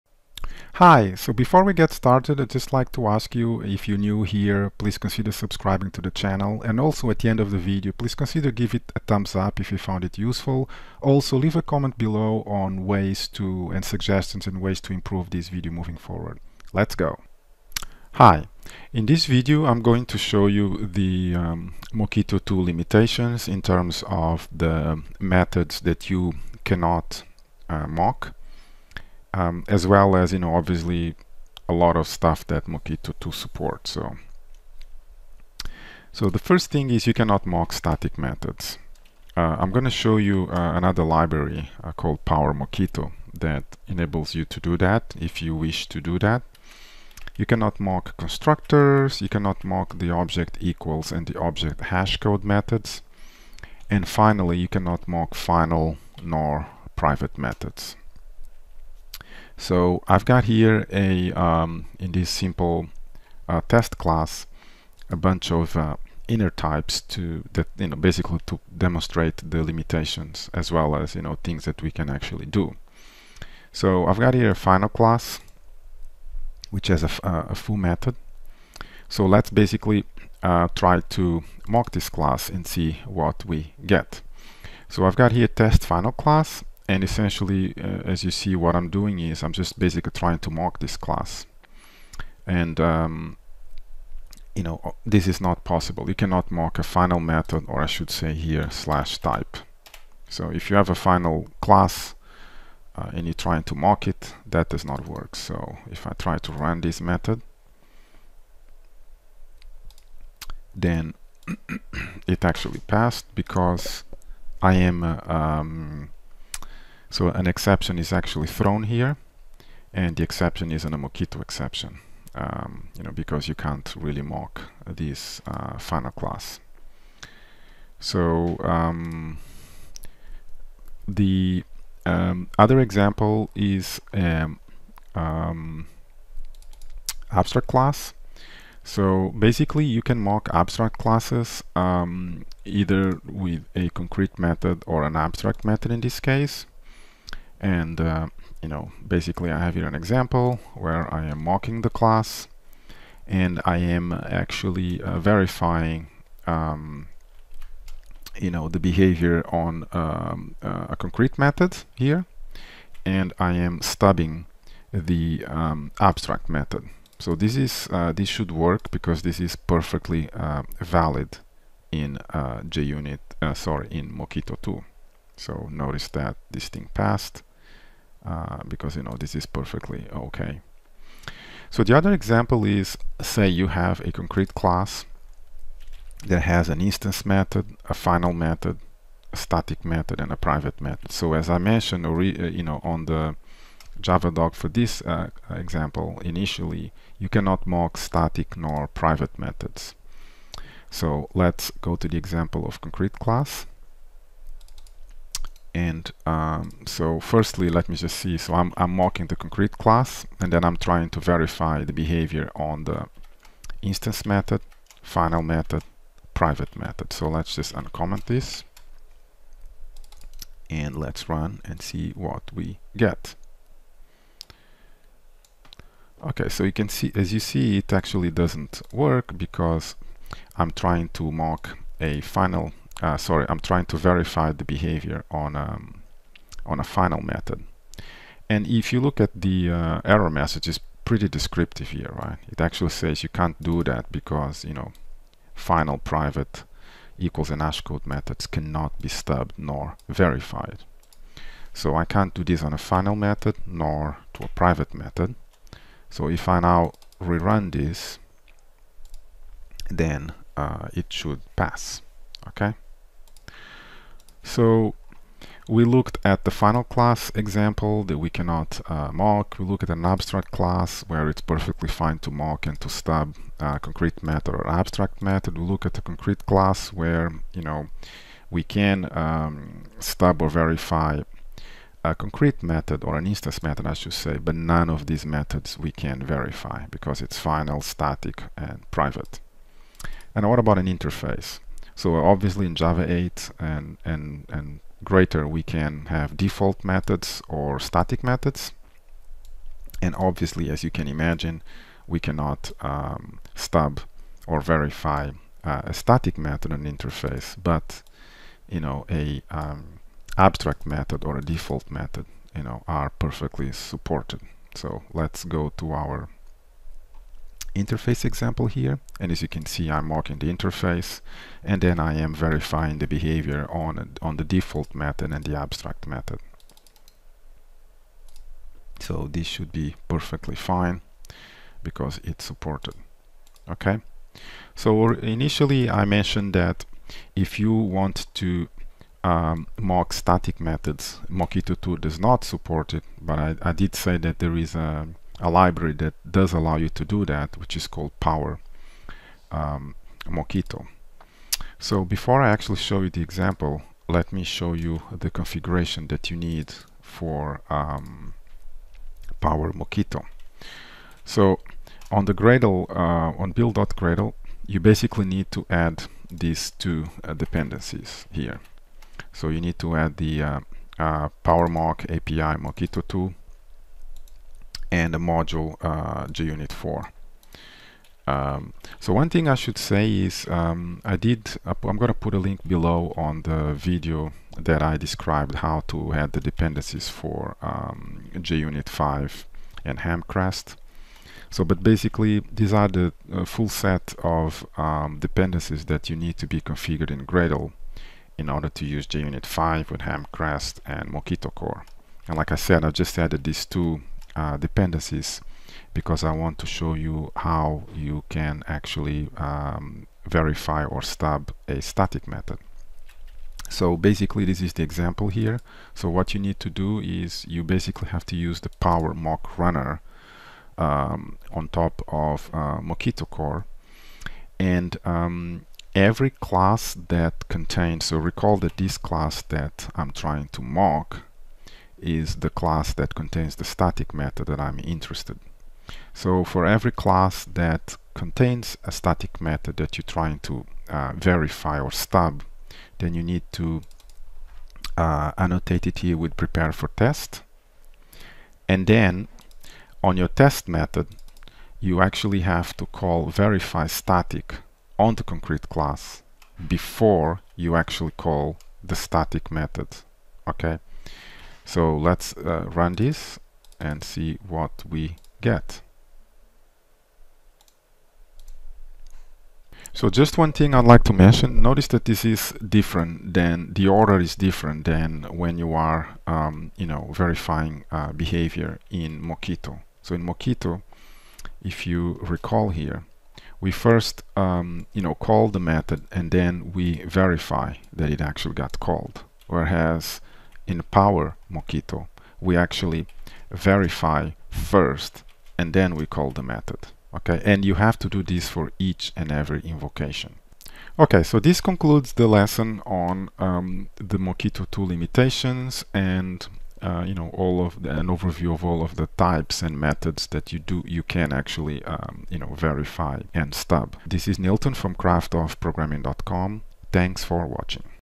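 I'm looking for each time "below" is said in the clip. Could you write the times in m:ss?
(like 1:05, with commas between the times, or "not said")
0:11, 6:22.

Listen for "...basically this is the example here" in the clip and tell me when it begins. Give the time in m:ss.
6:53.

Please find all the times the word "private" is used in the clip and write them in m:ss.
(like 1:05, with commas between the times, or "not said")
0:56, 3:10, 3:18, 3:36, 4:05, 4:14, 4:48.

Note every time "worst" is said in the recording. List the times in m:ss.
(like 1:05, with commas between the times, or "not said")
not said.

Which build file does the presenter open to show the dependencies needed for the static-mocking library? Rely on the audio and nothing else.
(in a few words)
build.gradle.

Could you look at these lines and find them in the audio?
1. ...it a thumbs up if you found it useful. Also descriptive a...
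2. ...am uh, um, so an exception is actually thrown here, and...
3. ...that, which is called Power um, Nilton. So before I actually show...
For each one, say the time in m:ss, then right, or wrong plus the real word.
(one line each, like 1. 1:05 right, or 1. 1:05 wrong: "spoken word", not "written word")
1. 0:08 wrong: "leave", not "descriptive"
2. 1:54 right
3. 5:47 wrong: "Mockito", not "Nilton".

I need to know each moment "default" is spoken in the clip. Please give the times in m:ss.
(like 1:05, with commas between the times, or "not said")
4:56, 5:11, 5:24.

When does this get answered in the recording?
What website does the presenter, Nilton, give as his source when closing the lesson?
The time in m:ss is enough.
8:34.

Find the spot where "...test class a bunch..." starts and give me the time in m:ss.
1:03.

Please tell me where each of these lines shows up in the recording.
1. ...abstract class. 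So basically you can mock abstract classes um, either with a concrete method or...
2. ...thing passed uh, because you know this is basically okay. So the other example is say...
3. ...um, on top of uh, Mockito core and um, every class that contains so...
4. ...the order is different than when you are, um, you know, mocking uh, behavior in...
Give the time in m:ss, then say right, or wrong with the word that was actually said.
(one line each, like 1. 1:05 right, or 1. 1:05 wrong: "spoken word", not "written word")
1. 2:17 right
2. 2:56 wrong: "perfectly", not "basically"
3. 7:00 right
4. 7:53 wrong: "verifying", not "mocking".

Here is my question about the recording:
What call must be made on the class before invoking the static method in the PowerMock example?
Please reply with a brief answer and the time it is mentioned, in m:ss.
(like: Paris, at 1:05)
verify static, at 7:33.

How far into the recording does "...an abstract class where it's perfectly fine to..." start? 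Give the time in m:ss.
4:29.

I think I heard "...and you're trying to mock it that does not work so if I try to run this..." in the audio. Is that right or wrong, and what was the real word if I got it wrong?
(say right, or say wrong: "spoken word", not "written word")
right.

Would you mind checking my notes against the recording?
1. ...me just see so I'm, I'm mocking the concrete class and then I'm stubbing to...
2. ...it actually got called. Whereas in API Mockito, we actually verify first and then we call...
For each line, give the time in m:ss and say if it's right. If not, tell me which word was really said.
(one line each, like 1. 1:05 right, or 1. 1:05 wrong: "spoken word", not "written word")
1. 3:27 wrong: "trying", not "stubbing"
2. 8:08 wrong: "Power", not "API".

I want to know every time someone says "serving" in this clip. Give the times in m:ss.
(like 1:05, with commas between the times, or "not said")
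not said.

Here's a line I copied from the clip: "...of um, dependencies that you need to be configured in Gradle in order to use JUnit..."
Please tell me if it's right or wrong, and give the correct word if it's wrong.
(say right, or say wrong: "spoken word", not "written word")
right.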